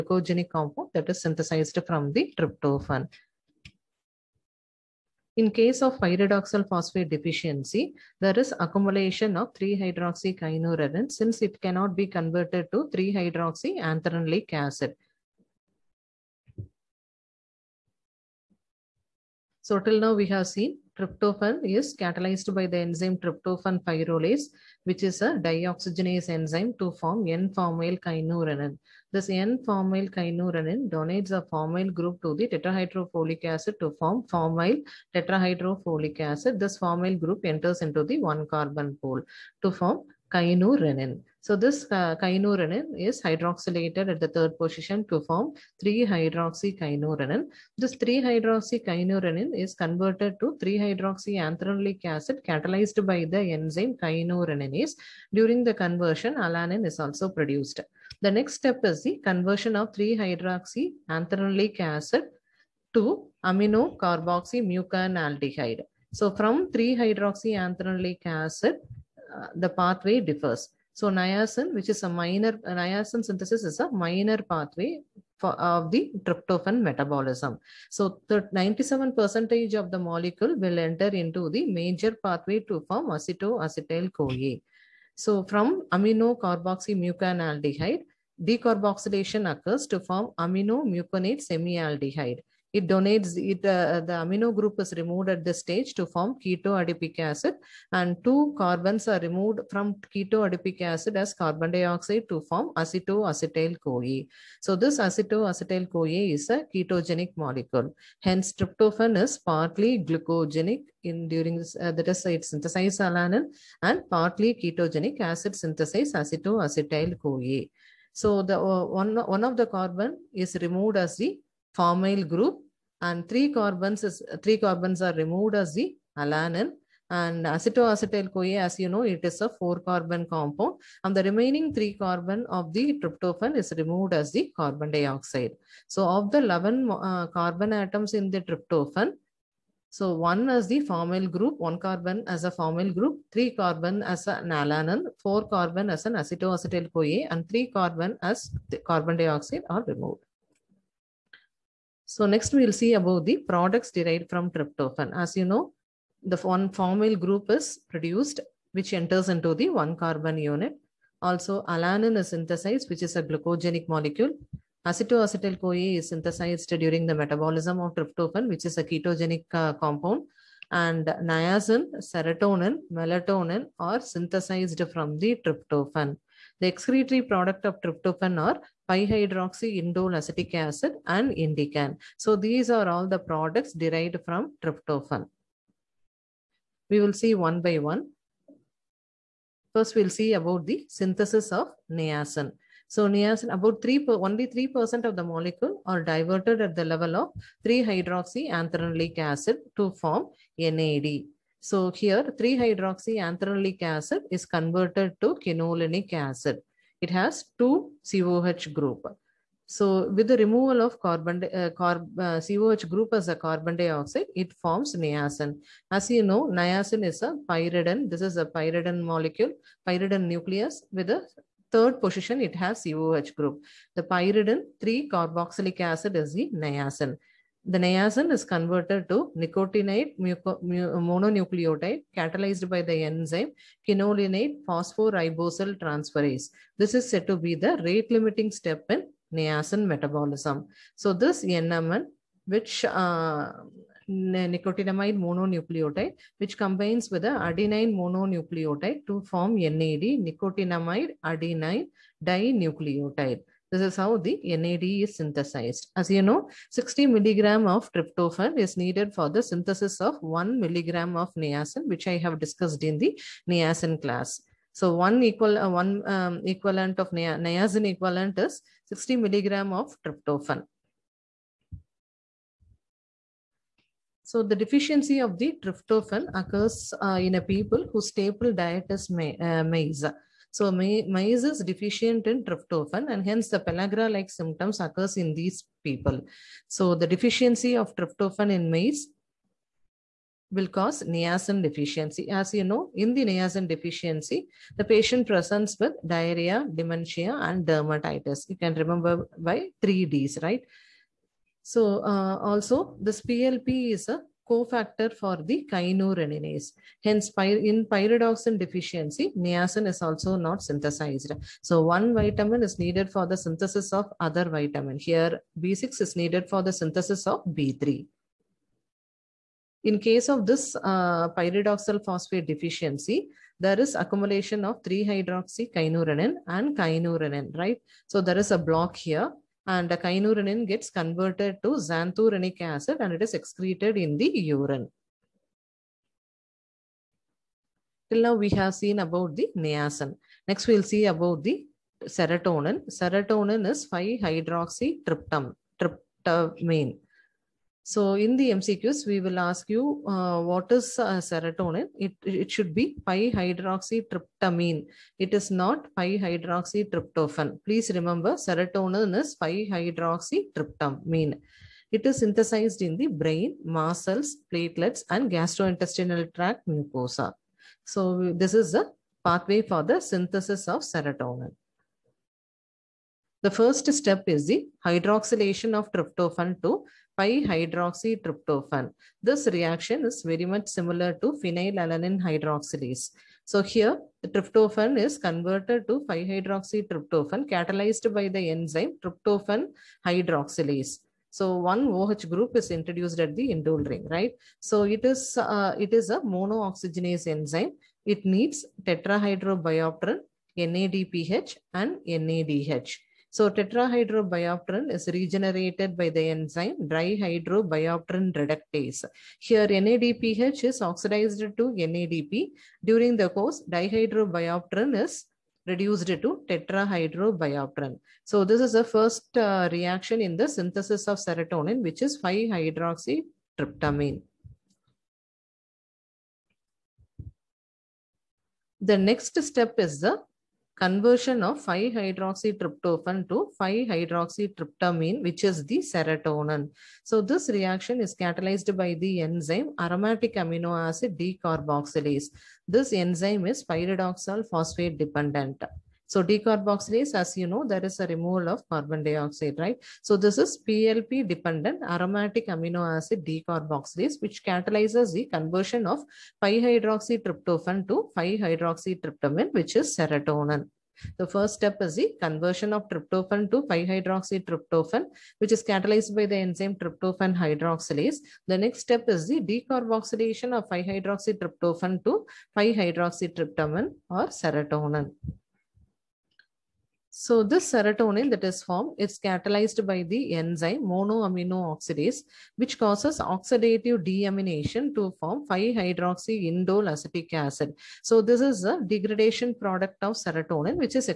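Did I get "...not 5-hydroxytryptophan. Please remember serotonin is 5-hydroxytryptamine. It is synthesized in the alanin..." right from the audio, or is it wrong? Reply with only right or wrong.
wrong.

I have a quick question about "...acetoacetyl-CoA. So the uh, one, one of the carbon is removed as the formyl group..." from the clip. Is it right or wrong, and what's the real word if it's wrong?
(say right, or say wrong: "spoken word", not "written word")
right.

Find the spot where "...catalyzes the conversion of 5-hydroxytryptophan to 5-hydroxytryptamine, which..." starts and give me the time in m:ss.
7:34.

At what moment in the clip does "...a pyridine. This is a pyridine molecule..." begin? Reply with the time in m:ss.
3:37.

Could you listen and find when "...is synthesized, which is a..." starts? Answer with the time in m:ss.
2:42.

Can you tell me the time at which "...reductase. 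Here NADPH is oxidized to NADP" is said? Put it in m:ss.
6:48.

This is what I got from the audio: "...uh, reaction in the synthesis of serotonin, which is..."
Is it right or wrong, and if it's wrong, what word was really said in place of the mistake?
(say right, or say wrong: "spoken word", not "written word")
right.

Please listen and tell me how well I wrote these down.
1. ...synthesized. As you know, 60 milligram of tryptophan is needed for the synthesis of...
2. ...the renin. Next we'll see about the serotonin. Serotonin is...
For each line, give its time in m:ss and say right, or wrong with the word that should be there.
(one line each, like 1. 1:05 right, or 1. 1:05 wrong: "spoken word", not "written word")
1. 4:15 right
2. 5:39 wrong: "niacin", not "renin".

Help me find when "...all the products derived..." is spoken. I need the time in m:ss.
3:02.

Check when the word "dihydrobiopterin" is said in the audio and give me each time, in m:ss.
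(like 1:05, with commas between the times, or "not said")
6:46, 6:53.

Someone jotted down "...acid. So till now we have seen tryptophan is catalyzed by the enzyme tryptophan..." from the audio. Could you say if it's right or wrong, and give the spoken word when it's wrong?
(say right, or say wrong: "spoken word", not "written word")
right.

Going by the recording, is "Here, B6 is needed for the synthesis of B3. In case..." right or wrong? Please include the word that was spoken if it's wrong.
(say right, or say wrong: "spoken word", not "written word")
right.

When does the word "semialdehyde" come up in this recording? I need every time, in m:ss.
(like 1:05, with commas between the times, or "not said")
1:31.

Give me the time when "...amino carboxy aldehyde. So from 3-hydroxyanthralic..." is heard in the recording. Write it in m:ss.
1:03.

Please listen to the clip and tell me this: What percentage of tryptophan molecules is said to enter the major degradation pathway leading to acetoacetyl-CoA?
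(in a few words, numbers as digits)
97.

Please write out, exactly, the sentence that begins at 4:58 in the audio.
You can remember by 3Ds, right?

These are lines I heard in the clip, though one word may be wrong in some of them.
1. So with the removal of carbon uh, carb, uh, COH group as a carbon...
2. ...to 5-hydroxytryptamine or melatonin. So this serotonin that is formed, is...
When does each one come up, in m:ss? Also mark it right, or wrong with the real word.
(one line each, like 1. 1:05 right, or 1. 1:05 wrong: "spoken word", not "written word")
1. 3:29 right
2. 7:52 wrong: "serotonin", not "melatonin".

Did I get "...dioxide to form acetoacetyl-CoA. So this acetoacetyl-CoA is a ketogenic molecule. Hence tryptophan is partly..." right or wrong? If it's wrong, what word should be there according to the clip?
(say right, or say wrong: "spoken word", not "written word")
right.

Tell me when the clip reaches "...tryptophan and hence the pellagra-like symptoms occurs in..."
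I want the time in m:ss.
4:42.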